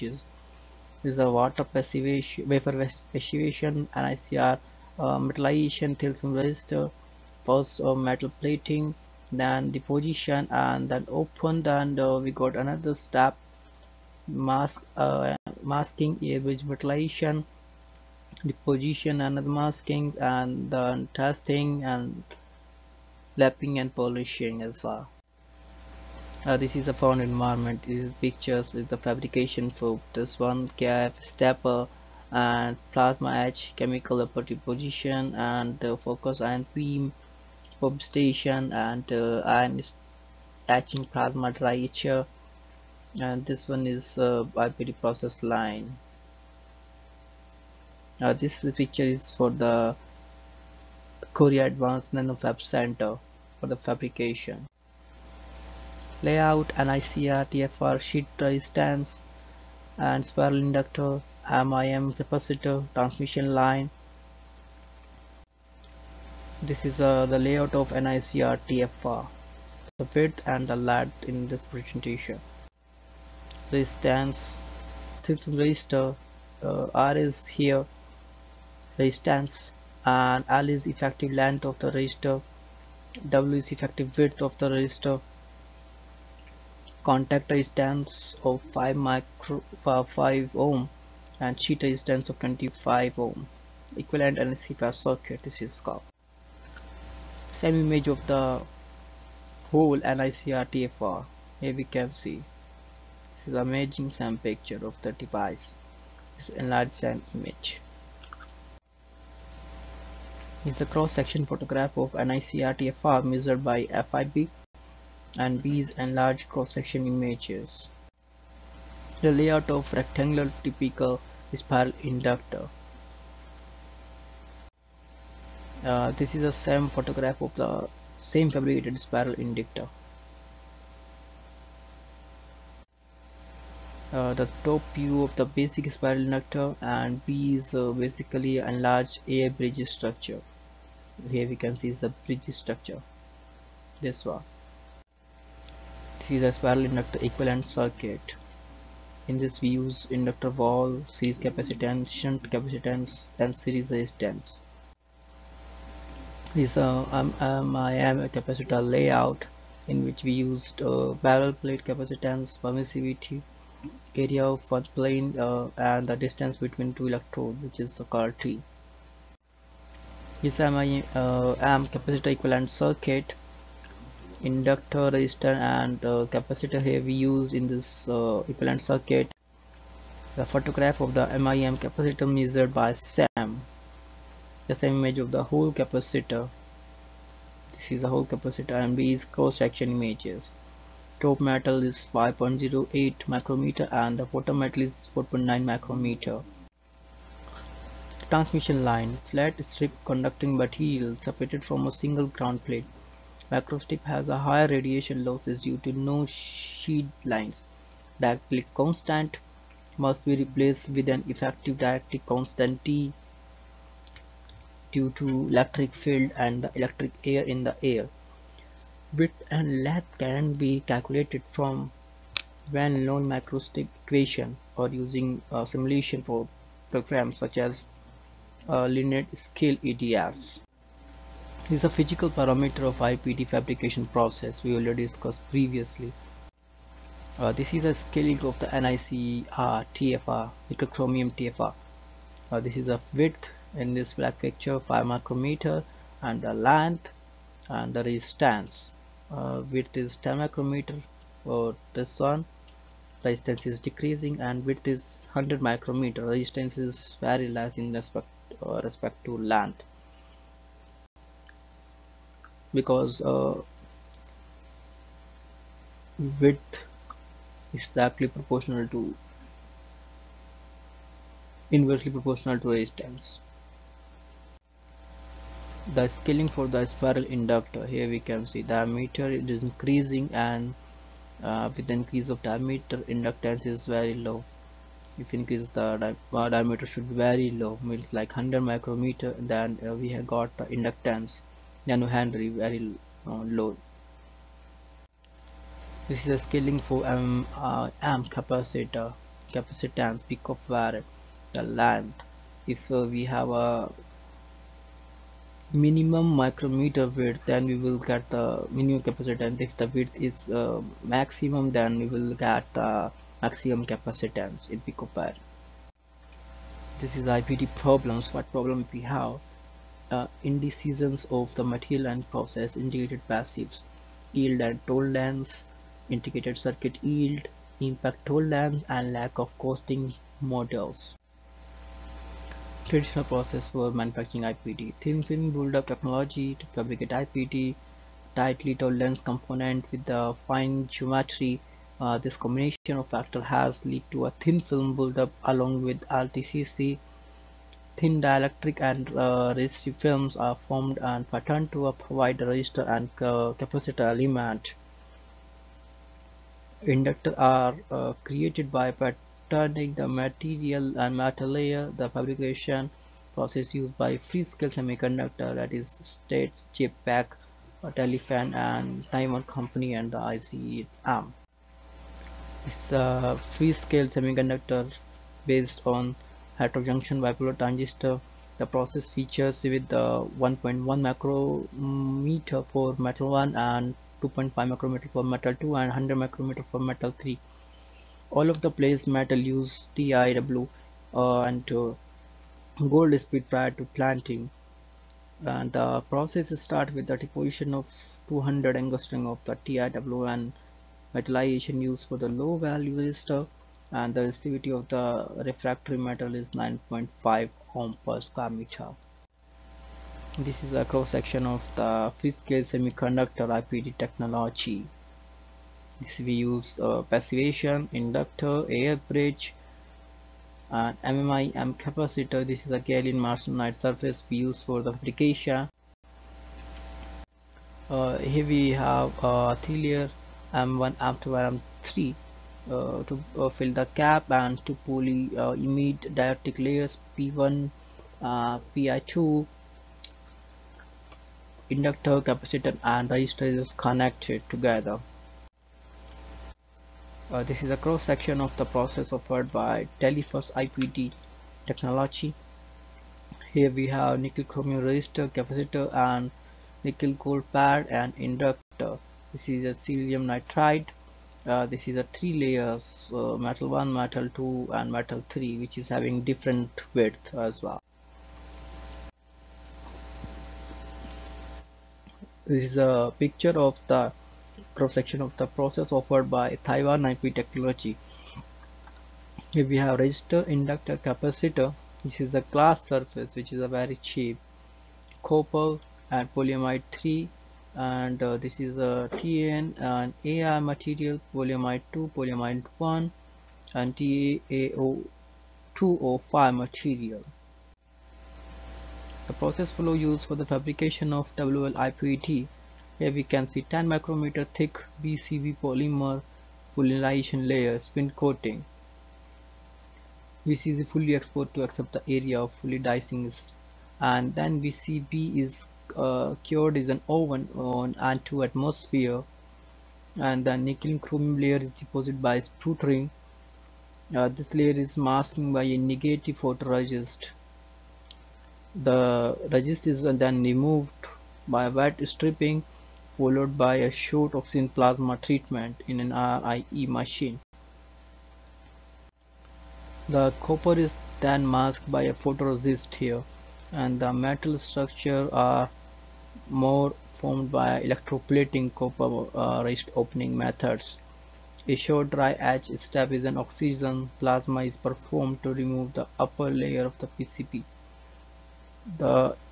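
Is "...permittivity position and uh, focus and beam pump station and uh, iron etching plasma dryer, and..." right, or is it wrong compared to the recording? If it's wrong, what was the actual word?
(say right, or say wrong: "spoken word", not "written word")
wrong: "property", not "permittivity".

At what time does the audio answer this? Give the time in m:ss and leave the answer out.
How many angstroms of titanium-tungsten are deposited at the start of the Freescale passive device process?
6:38.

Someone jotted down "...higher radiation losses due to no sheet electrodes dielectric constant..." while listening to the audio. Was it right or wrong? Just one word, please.
wrong.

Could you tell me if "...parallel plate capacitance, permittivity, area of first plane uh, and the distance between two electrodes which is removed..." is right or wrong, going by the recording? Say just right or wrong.
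wrong.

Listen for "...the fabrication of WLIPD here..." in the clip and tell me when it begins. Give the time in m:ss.
8:20.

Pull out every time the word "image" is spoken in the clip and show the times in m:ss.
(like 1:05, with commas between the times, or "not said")
1:37, 1:47, 1:57, 3:04, 3:09.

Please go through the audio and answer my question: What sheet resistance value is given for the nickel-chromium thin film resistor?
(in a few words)
25 ohm.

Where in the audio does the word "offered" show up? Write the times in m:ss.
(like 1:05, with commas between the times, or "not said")
7:29, 7:55.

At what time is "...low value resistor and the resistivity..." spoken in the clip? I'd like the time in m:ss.
6:42.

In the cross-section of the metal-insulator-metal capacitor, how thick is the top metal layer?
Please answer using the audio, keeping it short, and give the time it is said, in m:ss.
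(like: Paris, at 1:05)
5.08 micrometer, at 3:12.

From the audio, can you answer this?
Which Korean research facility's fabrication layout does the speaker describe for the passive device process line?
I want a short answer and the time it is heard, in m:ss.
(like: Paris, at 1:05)
Korea Advanced NanoFab Center, at 0:51.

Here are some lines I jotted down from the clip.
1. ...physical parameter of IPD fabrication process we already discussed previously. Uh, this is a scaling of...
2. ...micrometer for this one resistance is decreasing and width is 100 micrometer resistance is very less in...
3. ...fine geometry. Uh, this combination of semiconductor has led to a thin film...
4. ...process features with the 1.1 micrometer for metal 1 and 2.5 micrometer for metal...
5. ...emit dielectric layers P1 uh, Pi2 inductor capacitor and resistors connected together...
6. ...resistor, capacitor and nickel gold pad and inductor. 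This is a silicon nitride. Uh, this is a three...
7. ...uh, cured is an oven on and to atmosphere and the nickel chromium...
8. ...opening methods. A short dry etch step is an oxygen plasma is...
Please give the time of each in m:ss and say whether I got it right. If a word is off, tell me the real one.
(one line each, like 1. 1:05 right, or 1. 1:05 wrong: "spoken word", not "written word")
1. 3:51 right
2. 4:10 right
3. 5:40 wrong: "factor", not "semiconductor"
4. 6:18 right
5. 7:15 right
6. 7:34 right
7. 8:35 right
8. 9:09 right.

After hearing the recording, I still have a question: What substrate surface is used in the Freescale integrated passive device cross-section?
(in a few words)
gallium arsenide.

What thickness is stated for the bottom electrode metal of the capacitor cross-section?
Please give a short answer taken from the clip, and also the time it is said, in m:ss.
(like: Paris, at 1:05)
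4.9 micrometer, at 3:15.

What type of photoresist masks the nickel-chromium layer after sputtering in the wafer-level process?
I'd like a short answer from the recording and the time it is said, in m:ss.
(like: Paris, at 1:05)
negative photoresist, at 8:45.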